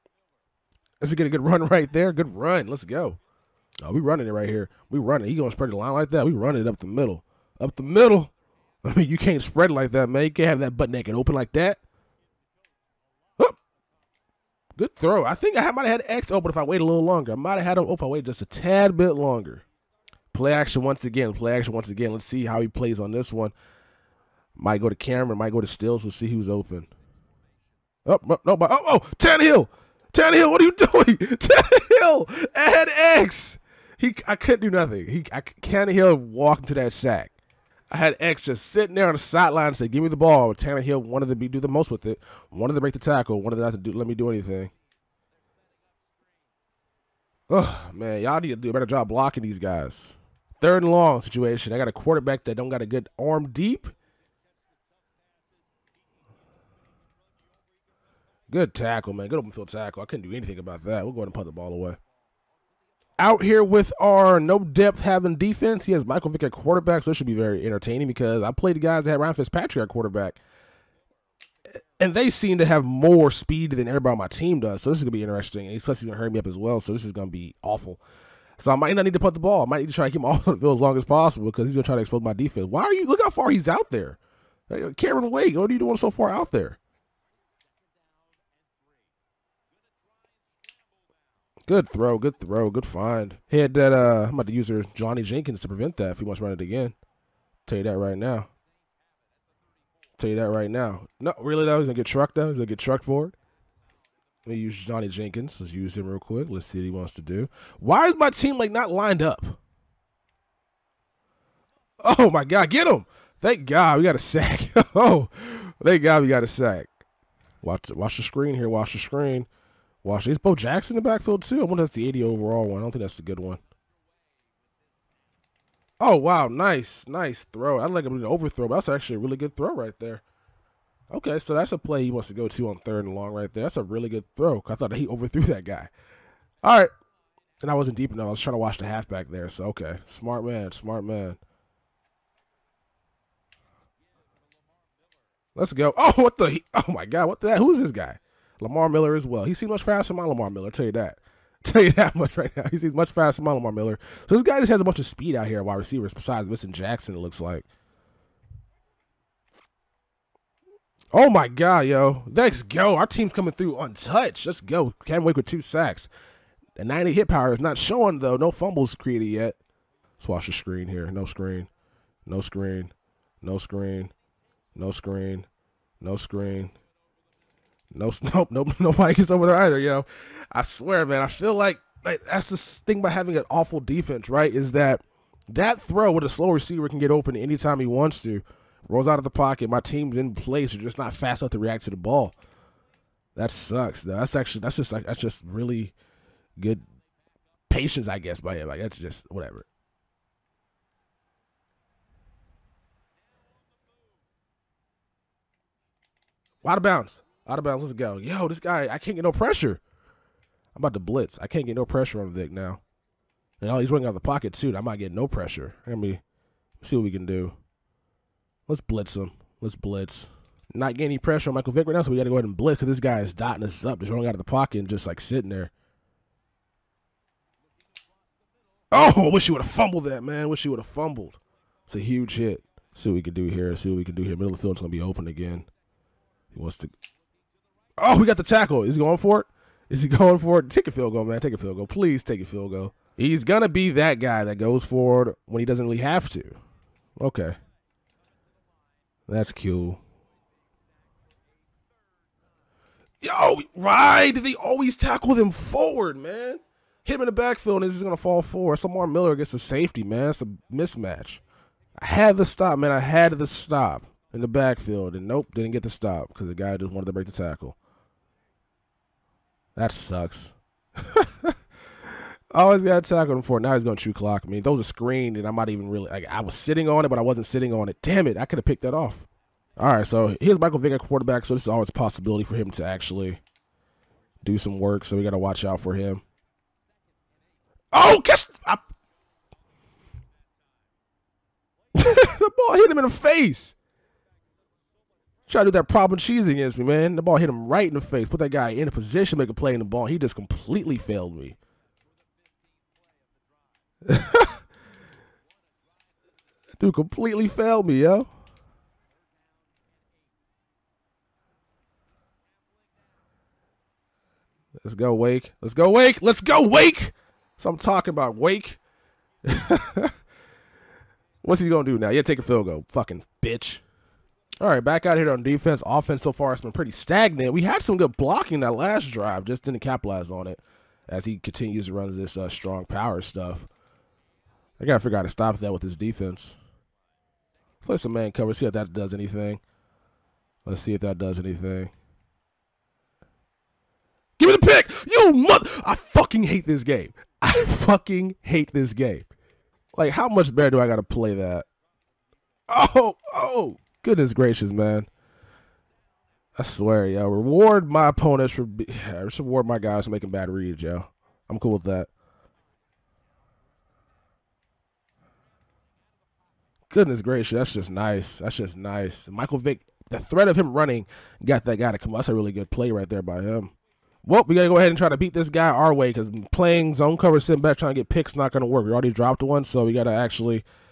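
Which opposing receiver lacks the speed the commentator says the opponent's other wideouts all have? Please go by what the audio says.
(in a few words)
Vincent Jackson.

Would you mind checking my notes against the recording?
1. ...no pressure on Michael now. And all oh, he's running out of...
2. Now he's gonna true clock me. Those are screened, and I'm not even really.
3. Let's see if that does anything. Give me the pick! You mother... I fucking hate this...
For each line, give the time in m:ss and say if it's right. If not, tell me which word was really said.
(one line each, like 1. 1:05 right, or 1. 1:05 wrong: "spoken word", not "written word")
1. 3:31 wrong: "Vick", not "Michael"
2. 4:33 right
3. 5:40 right.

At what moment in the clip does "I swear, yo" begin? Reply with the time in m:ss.
5:56.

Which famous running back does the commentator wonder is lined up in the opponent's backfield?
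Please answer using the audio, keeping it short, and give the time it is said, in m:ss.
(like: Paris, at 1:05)
Bo Jackson, at 2:00.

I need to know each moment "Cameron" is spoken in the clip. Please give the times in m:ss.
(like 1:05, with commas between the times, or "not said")
0:24, 1:24.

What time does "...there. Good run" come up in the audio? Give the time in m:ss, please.
0:01.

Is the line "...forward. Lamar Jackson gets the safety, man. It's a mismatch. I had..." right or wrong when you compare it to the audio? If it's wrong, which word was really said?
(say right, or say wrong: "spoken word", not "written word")
wrong: "Miller", not "Jackson".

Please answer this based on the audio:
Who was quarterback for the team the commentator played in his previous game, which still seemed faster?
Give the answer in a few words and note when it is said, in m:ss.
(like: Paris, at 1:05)
Ryan Fitzpatrick, at 1:09.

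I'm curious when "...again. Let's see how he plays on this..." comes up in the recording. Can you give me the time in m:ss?
0:21.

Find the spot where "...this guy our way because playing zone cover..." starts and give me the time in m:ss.
6:15.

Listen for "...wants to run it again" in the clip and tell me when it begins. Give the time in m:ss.
1:36.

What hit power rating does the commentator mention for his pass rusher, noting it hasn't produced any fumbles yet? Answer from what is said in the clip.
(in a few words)
90.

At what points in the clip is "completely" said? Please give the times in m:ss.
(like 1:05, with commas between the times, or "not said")
5:00, 5:06.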